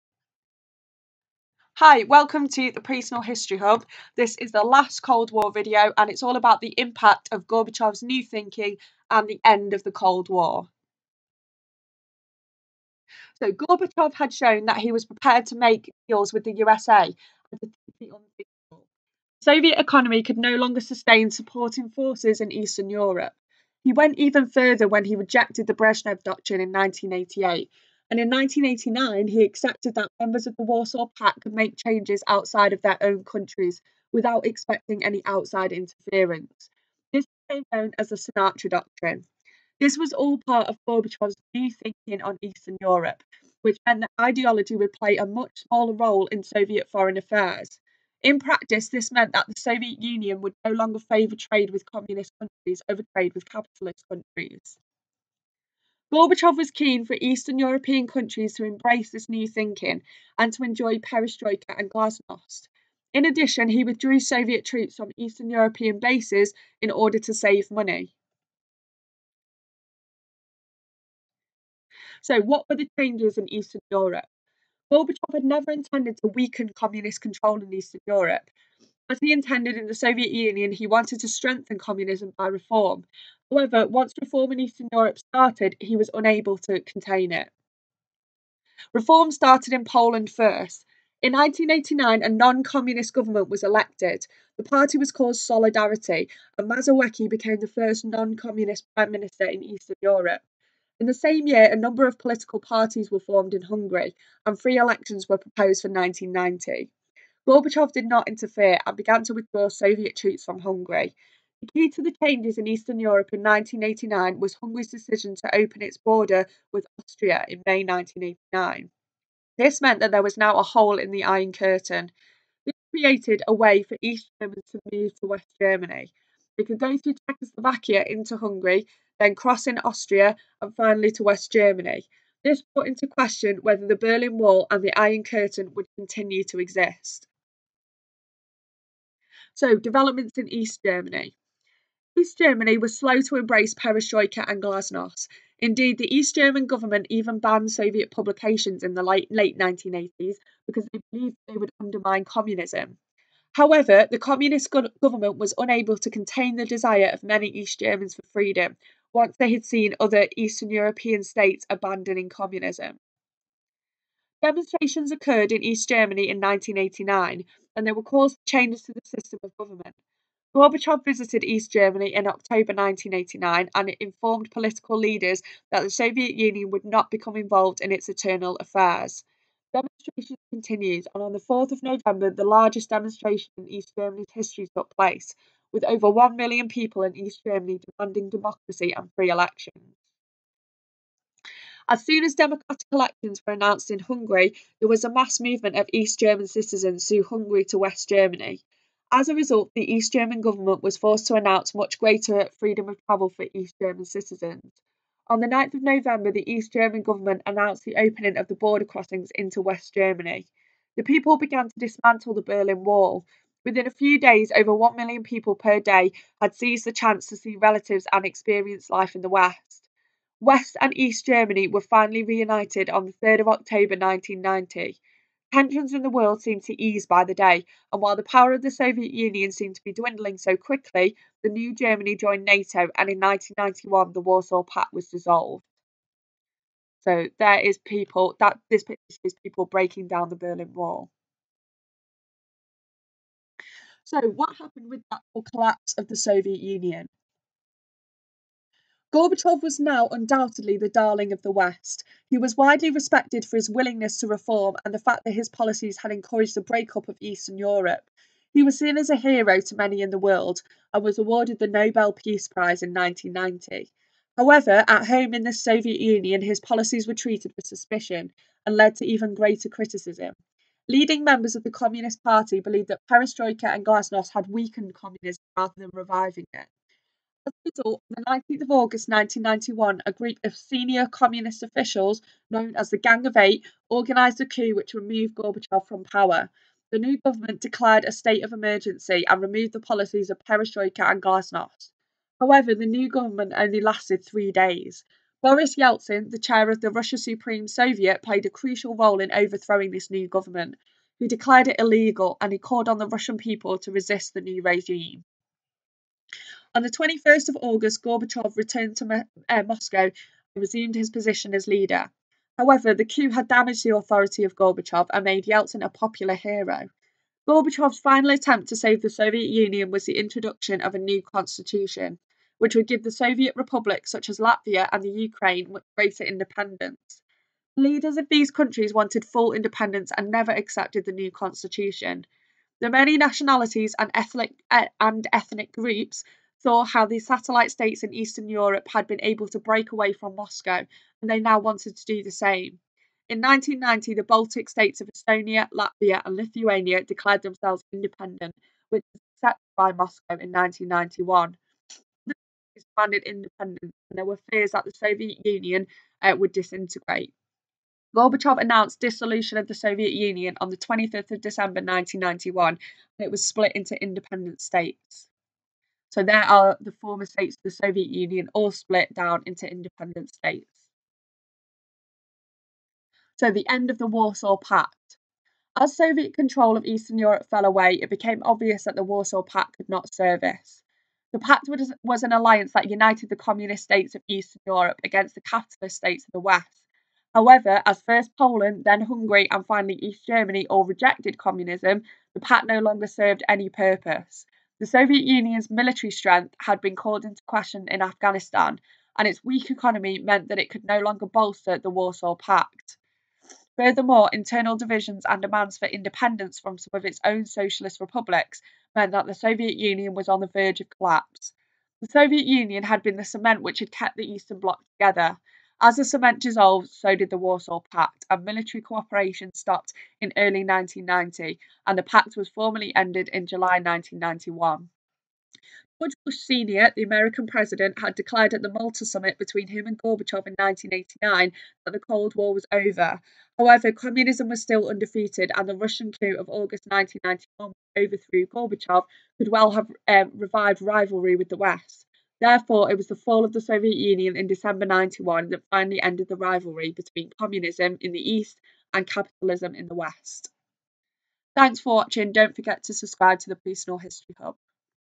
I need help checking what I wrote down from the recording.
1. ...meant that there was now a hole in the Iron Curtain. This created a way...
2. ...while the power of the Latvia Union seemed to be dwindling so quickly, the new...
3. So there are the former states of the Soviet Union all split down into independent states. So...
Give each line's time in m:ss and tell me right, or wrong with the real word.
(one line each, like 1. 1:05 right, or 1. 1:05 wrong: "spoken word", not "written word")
1. 1:59 right
2. 3:48 wrong: "Soviet", not "Latvia"
3. 6:06 right.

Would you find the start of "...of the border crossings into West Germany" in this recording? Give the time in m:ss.
3:28.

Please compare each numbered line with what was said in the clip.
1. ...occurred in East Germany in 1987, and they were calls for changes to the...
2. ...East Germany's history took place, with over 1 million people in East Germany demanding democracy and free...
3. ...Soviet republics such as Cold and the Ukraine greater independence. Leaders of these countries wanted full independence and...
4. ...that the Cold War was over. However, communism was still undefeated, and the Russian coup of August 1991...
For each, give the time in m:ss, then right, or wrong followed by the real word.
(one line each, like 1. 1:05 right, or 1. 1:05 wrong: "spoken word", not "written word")
1. 2:45 wrong: "1989", not "1987"
2. 3:03 right
3. 5:23 wrong: "Latvia", not "Cold"
4. 7:11 right.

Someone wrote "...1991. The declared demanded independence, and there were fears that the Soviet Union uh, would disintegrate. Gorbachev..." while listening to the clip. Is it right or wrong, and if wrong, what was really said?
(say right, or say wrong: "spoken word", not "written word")
right.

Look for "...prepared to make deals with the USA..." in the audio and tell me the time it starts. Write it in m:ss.
0:15.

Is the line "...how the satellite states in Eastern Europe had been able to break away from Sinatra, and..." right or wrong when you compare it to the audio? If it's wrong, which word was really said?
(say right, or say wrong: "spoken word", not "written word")
wrong: "Moscow", not "Sinatra".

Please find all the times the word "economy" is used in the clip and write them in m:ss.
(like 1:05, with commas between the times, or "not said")
0:19, 6:39.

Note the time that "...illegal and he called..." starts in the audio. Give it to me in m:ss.
5:01.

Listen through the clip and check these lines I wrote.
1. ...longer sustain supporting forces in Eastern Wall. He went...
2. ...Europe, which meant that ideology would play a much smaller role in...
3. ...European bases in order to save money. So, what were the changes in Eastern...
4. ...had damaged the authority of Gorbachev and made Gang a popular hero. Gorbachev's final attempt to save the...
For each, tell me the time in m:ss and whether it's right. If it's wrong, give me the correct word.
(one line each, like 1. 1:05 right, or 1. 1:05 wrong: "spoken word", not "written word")
1. 0:20 wrong: "Europe", not "Wall"
2. 0:42 right
3. 1:05 right
4. 5:13 wrong: "Yeltsin", not "Gang".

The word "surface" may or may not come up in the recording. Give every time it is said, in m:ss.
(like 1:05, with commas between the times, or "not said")
not said.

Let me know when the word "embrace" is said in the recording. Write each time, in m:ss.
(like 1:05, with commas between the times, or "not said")
0:58, 2:23.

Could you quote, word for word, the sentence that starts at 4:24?
However, at home in the Soviet Union, his policies were treated with suspicion and led to even greater criticism.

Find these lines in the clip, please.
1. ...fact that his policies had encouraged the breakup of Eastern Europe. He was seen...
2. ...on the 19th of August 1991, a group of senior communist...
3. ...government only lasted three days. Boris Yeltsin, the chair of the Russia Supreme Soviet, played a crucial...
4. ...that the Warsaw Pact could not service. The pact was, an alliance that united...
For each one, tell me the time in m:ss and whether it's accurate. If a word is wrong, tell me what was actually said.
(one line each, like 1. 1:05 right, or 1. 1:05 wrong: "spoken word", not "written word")
1. 4:14 right
2. 4:38 right
3. 4:53 right
4. 6:18 right.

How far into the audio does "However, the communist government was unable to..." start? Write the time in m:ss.
2:33.